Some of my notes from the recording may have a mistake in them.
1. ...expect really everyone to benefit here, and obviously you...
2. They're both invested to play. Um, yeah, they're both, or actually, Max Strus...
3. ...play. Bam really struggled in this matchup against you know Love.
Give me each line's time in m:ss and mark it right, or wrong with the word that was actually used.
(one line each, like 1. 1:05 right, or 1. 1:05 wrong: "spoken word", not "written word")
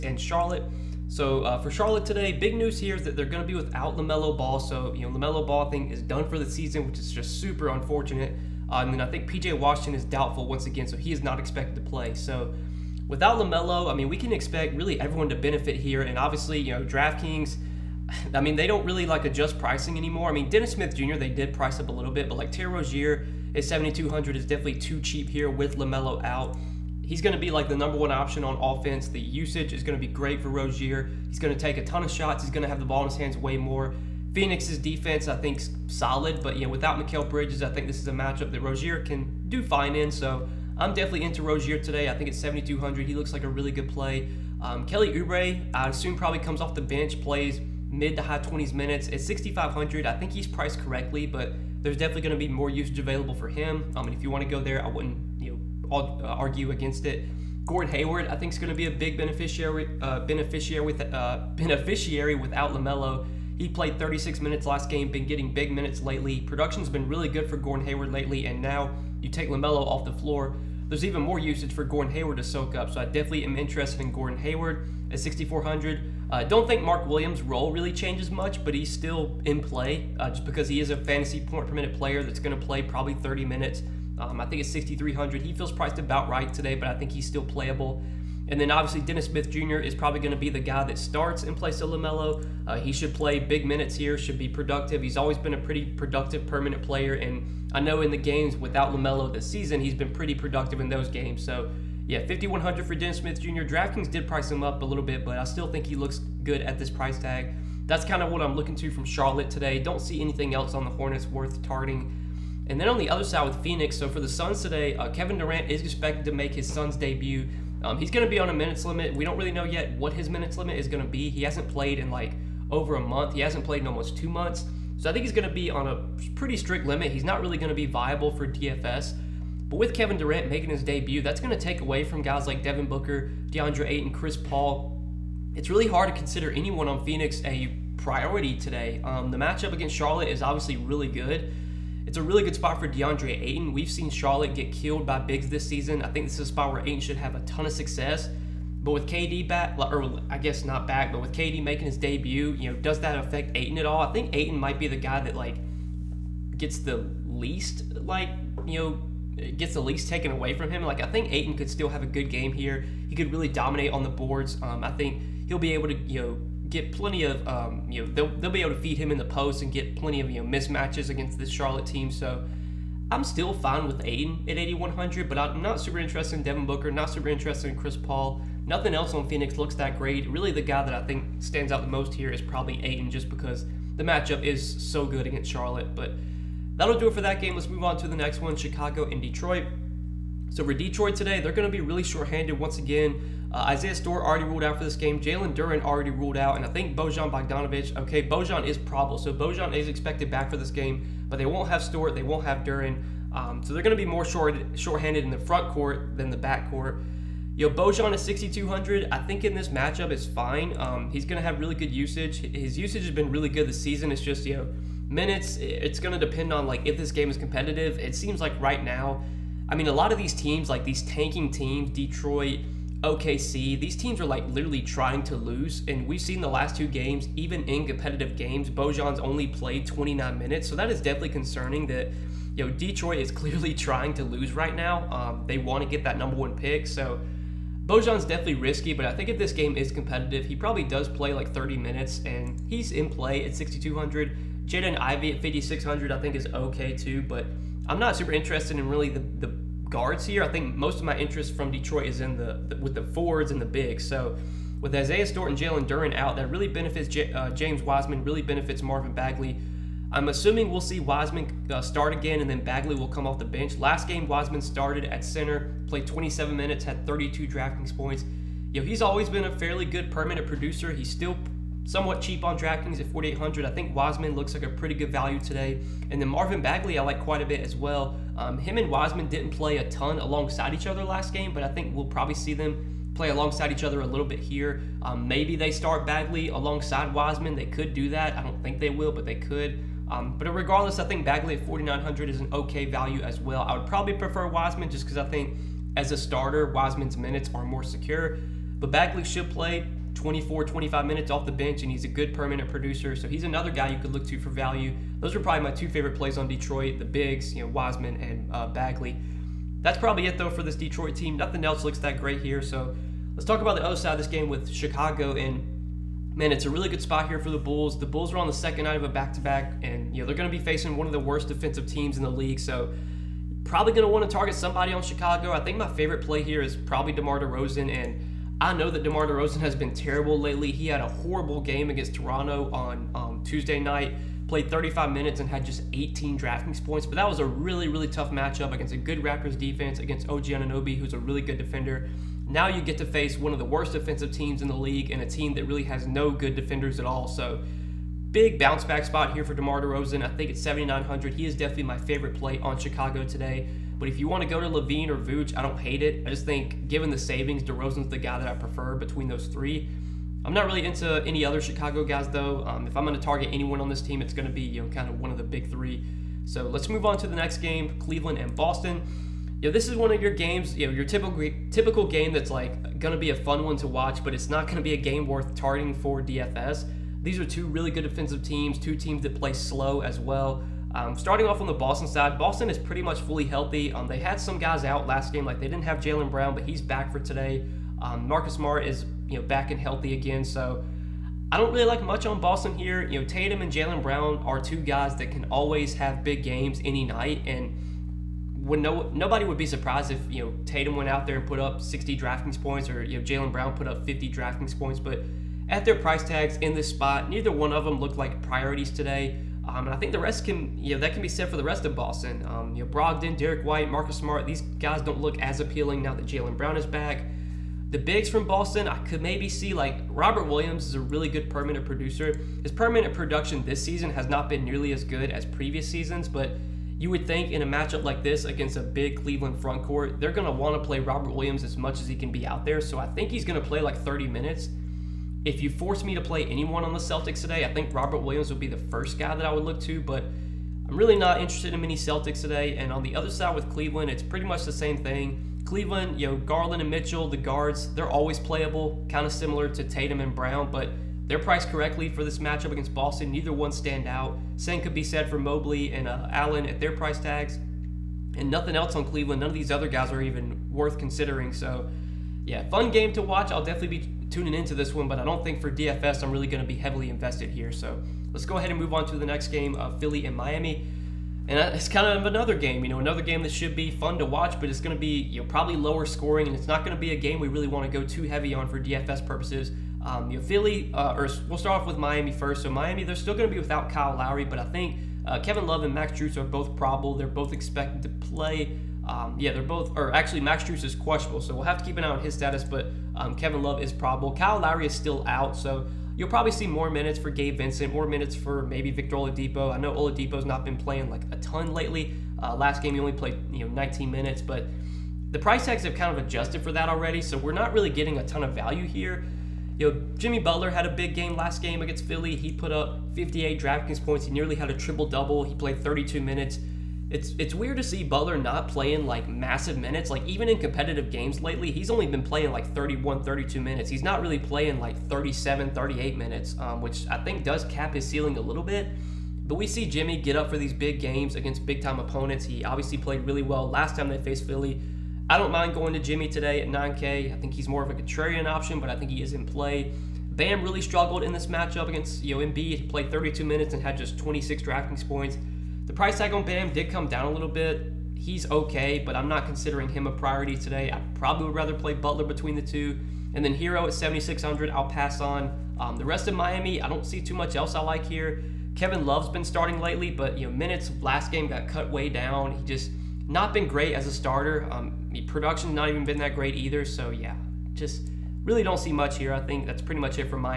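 1. 0:14 right
2. 8:07 wrong: "expected", not "invested"
3. 8:59 wrong: "Embiid", not "Love".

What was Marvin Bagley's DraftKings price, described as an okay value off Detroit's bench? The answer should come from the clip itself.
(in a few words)
4,900.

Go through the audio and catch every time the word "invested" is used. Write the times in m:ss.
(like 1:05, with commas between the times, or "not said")
7:47.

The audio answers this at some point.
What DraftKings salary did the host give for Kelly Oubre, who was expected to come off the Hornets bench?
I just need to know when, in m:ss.
0:49.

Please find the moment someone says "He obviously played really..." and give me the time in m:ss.
8:52.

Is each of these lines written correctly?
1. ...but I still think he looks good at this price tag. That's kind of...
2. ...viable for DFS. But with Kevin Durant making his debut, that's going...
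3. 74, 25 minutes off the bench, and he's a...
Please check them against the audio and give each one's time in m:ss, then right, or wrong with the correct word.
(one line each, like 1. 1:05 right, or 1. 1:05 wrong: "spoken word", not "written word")
1. 1:45 right
2. 2:07 right
3. 5:00 wrong: "24", not "74".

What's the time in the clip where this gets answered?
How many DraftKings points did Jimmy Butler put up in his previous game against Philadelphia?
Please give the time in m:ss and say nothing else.
8:33.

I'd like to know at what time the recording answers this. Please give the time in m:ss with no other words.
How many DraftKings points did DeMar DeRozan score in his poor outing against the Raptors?
5:35.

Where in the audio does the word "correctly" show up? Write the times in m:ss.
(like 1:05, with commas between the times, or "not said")
0:50, 7:31.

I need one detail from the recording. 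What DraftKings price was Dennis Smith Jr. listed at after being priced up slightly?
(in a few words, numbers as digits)
5,100.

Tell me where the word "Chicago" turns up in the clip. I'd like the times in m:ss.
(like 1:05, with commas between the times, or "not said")
3:08, 5:14, 5:25, 5:52, 6:01.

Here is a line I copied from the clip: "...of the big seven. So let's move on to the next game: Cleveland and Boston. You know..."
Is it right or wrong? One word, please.
wrong.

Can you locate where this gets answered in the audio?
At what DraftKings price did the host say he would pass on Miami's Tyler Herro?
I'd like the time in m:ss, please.
9:13.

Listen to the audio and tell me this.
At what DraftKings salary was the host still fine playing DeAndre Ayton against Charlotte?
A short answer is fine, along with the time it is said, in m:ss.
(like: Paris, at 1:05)
8100, at 2:54.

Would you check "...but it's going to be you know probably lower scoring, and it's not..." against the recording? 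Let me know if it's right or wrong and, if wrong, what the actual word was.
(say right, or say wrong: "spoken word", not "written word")
right.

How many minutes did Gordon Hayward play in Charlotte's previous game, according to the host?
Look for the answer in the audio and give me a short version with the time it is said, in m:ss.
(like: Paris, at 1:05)
36, at 1:03.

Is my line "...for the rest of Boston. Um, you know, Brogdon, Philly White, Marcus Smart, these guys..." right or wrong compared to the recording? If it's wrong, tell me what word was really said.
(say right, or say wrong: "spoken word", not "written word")
wrong: "Derrick", not "Philly".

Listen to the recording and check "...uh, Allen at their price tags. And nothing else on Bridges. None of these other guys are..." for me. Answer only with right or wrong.
wrong.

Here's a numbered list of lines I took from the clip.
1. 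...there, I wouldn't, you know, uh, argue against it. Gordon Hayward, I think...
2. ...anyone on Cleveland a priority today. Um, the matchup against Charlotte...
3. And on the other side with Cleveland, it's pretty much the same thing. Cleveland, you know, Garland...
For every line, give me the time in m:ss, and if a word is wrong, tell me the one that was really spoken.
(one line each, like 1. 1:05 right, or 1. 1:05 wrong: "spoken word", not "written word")
1. 0:54 right
2. 2:16 wrong: "Phoenix", not "Cleveland"
3. 7:22 right.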